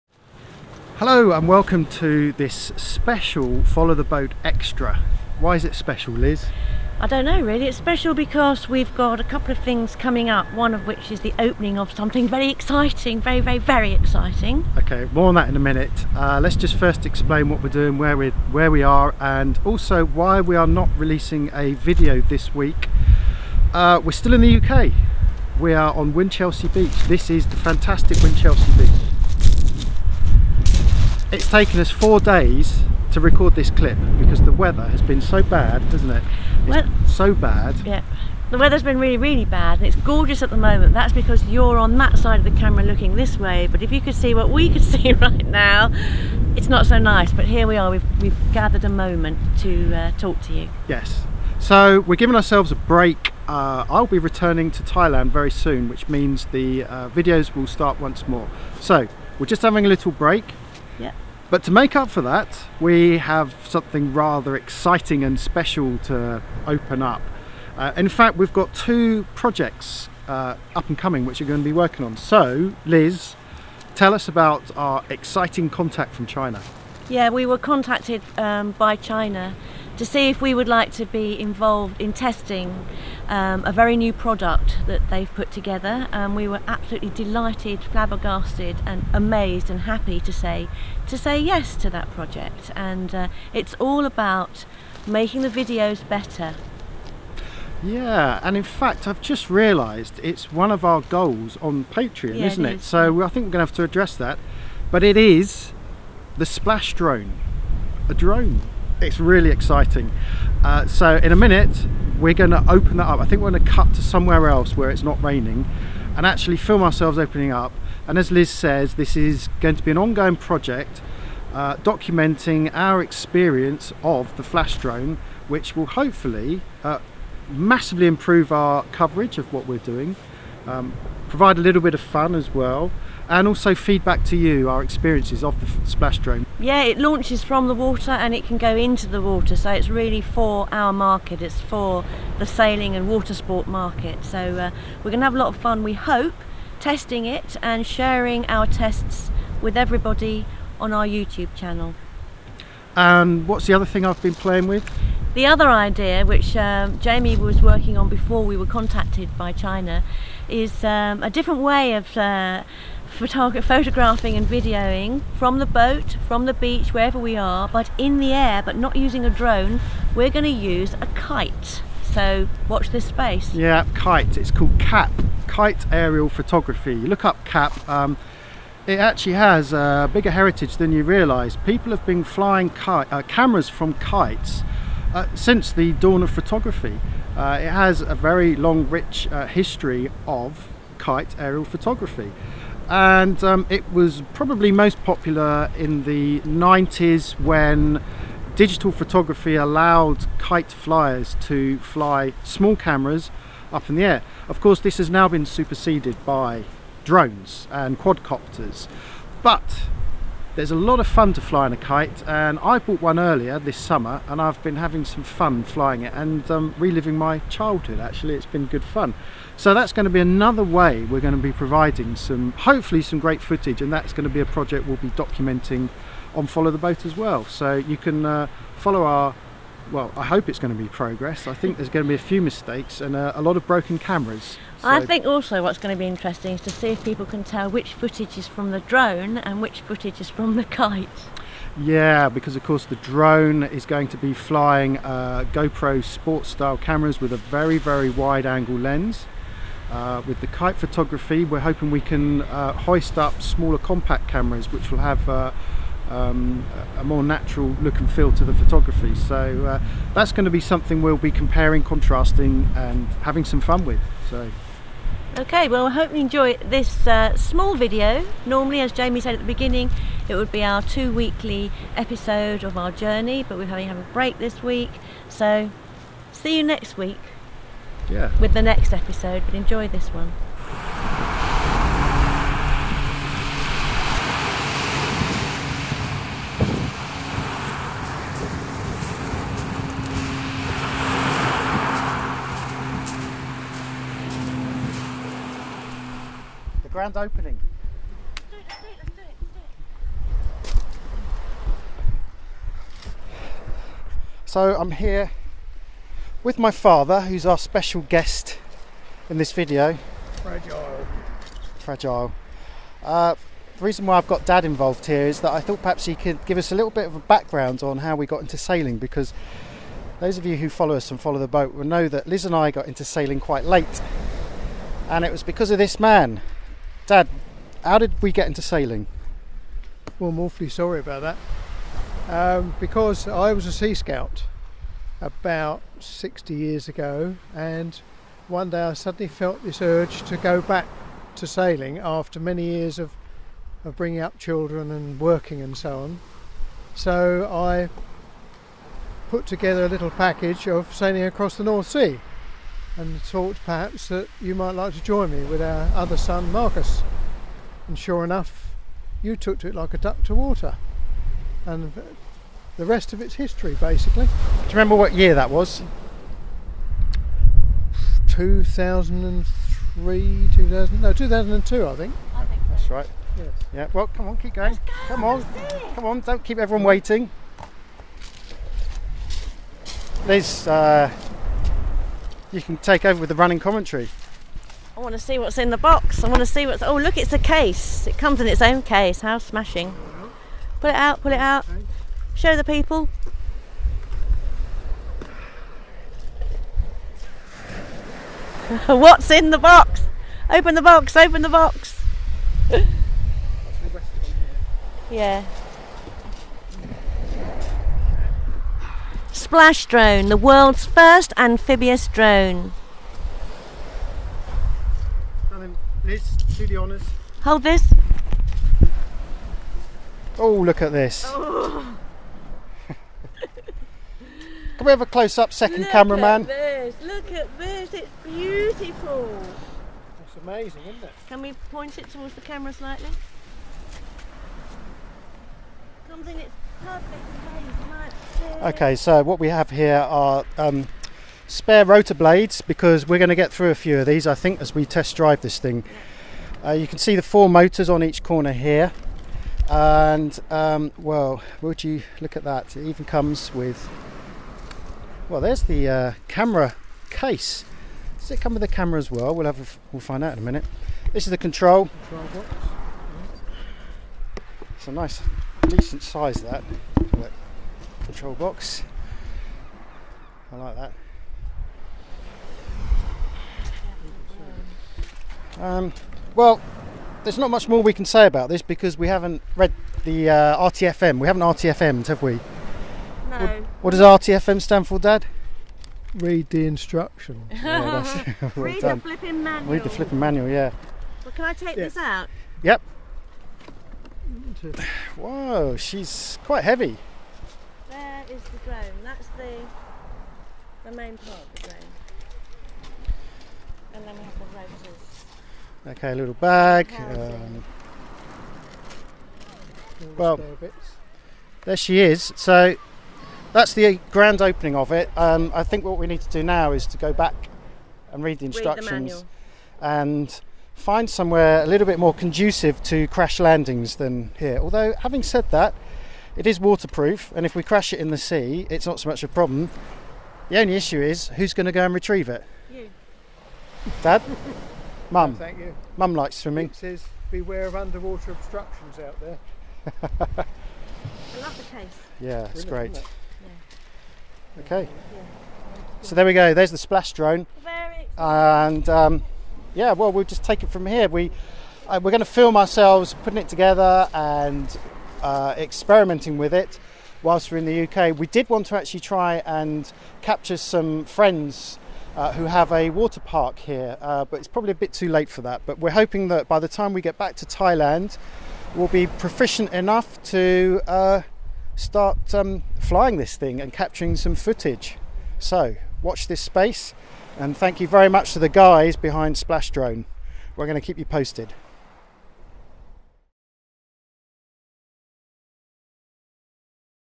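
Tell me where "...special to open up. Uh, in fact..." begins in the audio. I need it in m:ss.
1:05.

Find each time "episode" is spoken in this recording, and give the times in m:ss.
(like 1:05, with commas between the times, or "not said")
4:31, 4:38.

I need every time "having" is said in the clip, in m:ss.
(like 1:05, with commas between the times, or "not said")
0:59, 3:34, 4:23, 4:33, 8:45.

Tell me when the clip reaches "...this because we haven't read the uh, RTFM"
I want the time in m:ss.
7:58.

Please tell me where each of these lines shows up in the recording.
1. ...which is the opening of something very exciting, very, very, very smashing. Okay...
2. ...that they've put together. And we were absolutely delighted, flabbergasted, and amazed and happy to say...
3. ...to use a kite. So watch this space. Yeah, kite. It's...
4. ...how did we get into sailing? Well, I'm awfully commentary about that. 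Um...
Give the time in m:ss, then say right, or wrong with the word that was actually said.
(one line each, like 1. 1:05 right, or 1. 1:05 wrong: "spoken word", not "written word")
1. 0:10 wrong: "exciting", not "smashing"
2. 1:24 right
3. 2:50 right
4. 5:27 wrong: "sorry", not "commentary".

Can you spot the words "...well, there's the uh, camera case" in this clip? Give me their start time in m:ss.
7:35.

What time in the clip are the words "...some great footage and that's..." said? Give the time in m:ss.
3:43.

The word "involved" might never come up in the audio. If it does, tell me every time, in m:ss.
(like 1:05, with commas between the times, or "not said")
1:21, 5:14.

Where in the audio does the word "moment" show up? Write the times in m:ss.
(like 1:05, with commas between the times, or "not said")
0:40, 0:48.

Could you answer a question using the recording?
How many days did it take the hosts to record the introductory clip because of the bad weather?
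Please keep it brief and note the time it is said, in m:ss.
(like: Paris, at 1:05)
4, at 0:31.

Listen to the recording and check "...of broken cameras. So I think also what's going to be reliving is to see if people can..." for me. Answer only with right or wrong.
wrong.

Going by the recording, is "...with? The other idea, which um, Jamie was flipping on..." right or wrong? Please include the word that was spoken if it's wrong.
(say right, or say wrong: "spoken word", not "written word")
wrong: "working", not "flipping".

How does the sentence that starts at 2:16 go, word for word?
Yeah, it launches from the water and it can go into the water, so it's really for our market.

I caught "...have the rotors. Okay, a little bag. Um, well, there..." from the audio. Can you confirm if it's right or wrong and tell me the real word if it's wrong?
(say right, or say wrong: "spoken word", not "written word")
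right.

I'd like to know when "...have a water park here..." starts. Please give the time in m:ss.
9:22.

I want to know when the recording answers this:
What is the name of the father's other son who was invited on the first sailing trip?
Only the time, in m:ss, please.
5:56.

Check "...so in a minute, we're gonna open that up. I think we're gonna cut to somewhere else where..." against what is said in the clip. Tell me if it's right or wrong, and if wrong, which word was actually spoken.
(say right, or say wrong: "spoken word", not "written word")
right.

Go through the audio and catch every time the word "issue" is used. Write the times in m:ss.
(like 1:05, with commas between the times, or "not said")
8:50.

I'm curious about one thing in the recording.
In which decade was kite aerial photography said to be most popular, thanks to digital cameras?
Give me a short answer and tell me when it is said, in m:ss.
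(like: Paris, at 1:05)
the 90s, at 3:16.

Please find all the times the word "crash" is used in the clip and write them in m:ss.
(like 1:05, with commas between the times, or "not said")
8:43, 8:47.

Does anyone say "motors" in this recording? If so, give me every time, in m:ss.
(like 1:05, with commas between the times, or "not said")
7:27.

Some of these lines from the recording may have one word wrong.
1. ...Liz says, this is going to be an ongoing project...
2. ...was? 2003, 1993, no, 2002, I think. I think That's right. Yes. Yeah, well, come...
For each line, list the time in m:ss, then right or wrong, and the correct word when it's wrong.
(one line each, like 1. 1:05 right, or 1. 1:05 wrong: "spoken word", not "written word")
1. 1:58 right
2. 6:05 wrong: "2000", not "1993".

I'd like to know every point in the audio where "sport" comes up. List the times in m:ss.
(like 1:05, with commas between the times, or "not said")
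2:23, 4:06.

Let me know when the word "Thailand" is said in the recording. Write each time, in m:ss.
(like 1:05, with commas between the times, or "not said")
0:54, 9:27.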